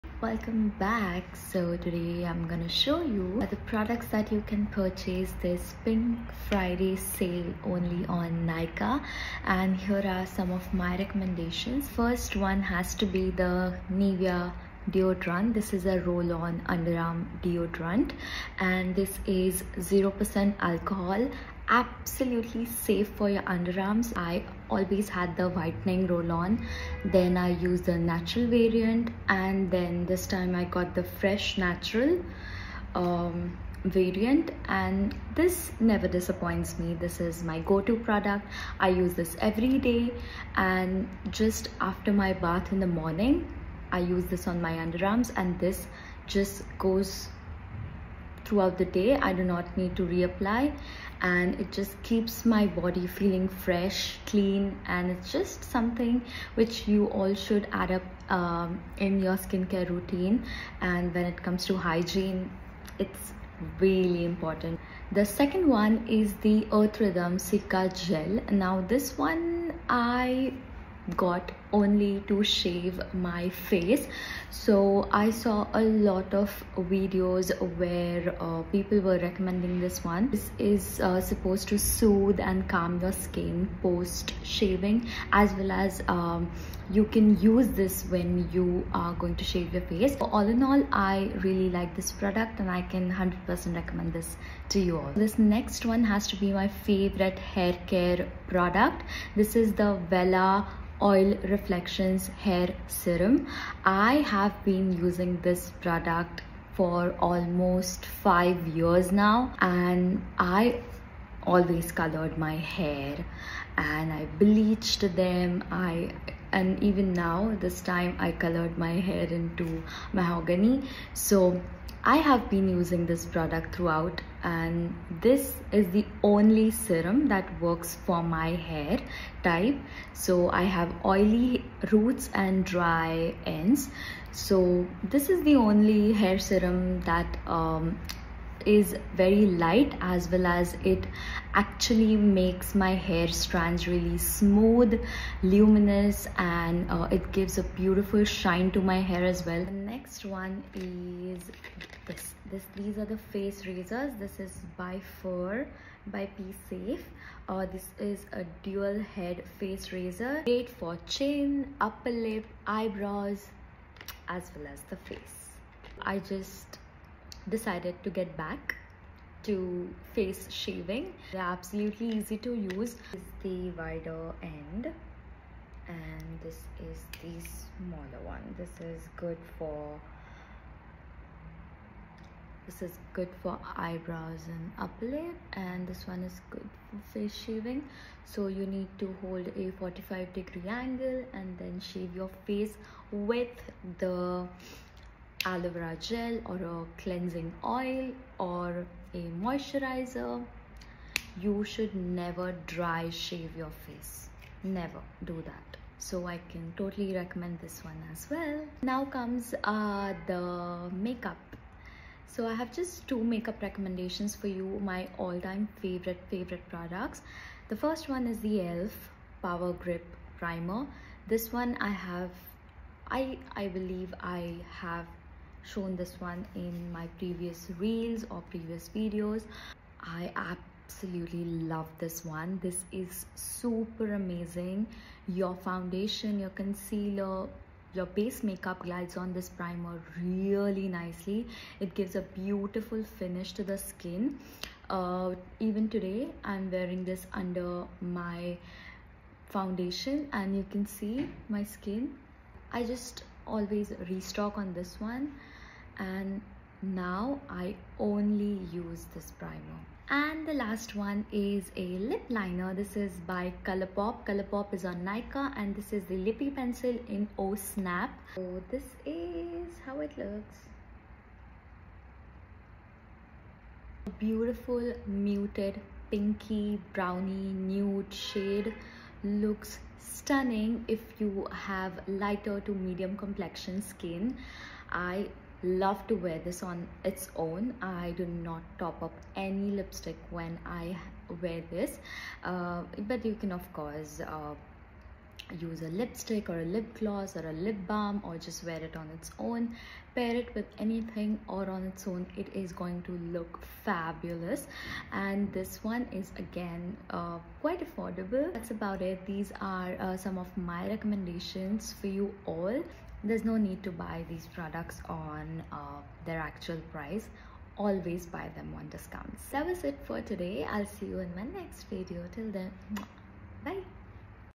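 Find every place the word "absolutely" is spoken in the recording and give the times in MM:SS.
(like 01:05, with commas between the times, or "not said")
00:21, 02:51, 03:50.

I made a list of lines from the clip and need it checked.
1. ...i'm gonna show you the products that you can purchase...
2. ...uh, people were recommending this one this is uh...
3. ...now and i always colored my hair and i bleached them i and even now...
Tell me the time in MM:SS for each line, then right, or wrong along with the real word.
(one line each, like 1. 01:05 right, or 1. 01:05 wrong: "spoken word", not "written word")
1. 00:02 right
2. 01:18 right
3. 01:49 right.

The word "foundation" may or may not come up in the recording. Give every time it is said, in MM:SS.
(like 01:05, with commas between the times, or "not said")
03:55, 04:09.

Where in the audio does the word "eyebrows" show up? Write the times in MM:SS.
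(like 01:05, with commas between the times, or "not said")
02:42, 03:03.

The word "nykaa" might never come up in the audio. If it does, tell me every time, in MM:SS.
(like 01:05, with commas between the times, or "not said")
00:08, 04:25.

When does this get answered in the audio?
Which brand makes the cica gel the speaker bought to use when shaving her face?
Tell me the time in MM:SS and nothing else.
01:06.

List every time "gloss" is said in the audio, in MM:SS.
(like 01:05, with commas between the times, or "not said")
04:56.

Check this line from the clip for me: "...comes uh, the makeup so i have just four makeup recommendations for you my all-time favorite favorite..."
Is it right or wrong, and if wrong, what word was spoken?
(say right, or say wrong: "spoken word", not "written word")
wrong: "two", not "four".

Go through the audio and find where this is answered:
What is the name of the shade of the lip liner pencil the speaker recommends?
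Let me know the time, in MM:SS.
04:27.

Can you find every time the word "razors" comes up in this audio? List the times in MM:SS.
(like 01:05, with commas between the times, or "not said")
02:33, 02:39.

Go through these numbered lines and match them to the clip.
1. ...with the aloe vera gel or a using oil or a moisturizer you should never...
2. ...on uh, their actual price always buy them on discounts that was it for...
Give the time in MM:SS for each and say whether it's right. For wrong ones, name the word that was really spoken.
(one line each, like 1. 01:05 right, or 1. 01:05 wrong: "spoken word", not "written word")
1. 03:13 wrong: "cleansing", not "using"
2. 05:15 right.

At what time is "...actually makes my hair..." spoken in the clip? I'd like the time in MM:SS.
02:21.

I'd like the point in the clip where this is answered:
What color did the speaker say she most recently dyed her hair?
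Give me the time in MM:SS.
02:00.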